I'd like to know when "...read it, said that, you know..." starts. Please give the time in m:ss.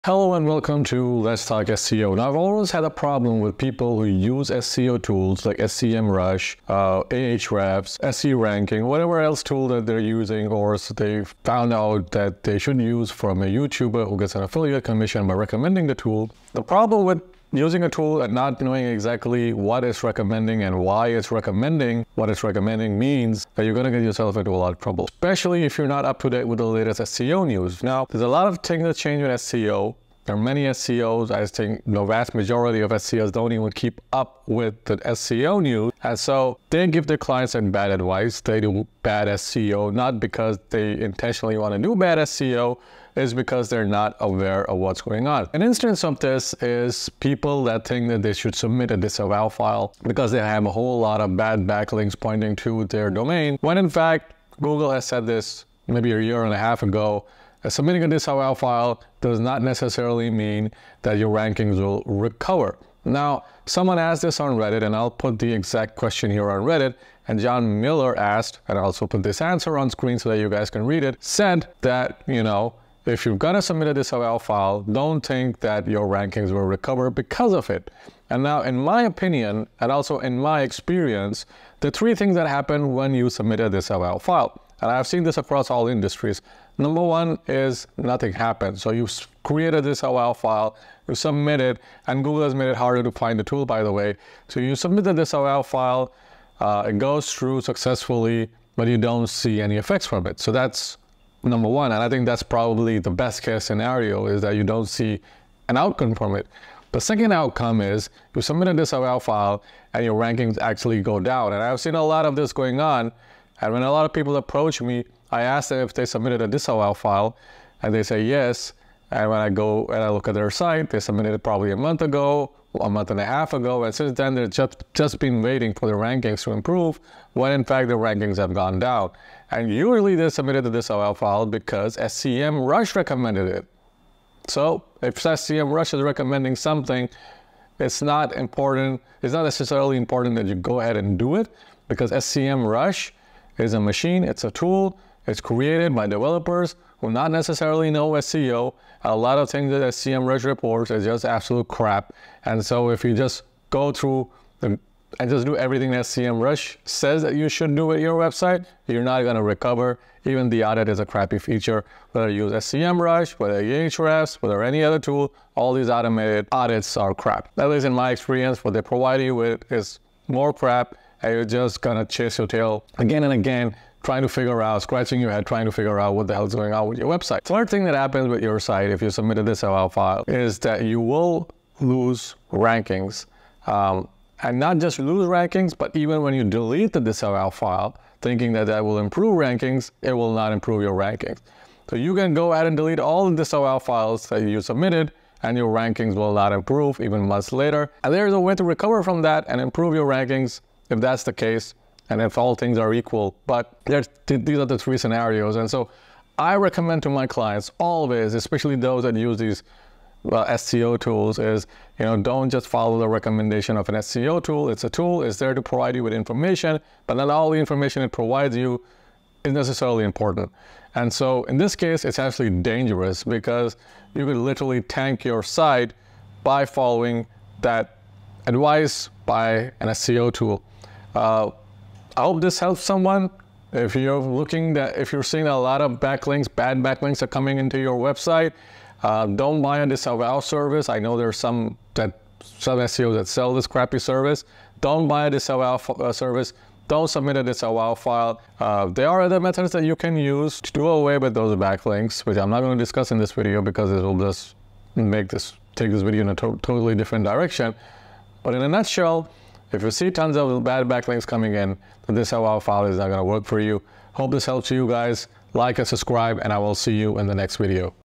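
1:10.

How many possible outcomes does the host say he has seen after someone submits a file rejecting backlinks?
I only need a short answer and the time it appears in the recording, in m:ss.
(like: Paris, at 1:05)
3, at 1:21.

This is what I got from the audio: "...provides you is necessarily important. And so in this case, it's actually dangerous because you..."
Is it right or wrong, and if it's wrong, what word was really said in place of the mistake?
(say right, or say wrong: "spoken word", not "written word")
right.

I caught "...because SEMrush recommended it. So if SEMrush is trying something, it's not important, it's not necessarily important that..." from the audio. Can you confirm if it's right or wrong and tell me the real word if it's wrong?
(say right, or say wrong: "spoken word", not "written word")
wrong: "recommending", not "trying".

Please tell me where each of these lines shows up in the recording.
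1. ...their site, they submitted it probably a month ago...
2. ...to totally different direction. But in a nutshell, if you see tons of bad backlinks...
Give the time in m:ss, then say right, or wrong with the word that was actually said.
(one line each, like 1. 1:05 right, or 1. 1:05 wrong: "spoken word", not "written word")
1. 2:00 right
2. 4:16 right.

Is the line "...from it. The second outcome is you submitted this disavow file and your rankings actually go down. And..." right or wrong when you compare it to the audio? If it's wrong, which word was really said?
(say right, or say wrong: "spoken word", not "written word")
right.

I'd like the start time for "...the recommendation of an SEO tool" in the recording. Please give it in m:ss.
3:32.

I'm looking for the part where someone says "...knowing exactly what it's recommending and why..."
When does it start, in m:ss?
0:18.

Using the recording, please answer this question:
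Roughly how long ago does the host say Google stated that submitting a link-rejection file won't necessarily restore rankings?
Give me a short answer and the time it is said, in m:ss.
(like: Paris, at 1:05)
a year and a half, at 0:56.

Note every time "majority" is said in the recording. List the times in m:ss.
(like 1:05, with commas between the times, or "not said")
0:32.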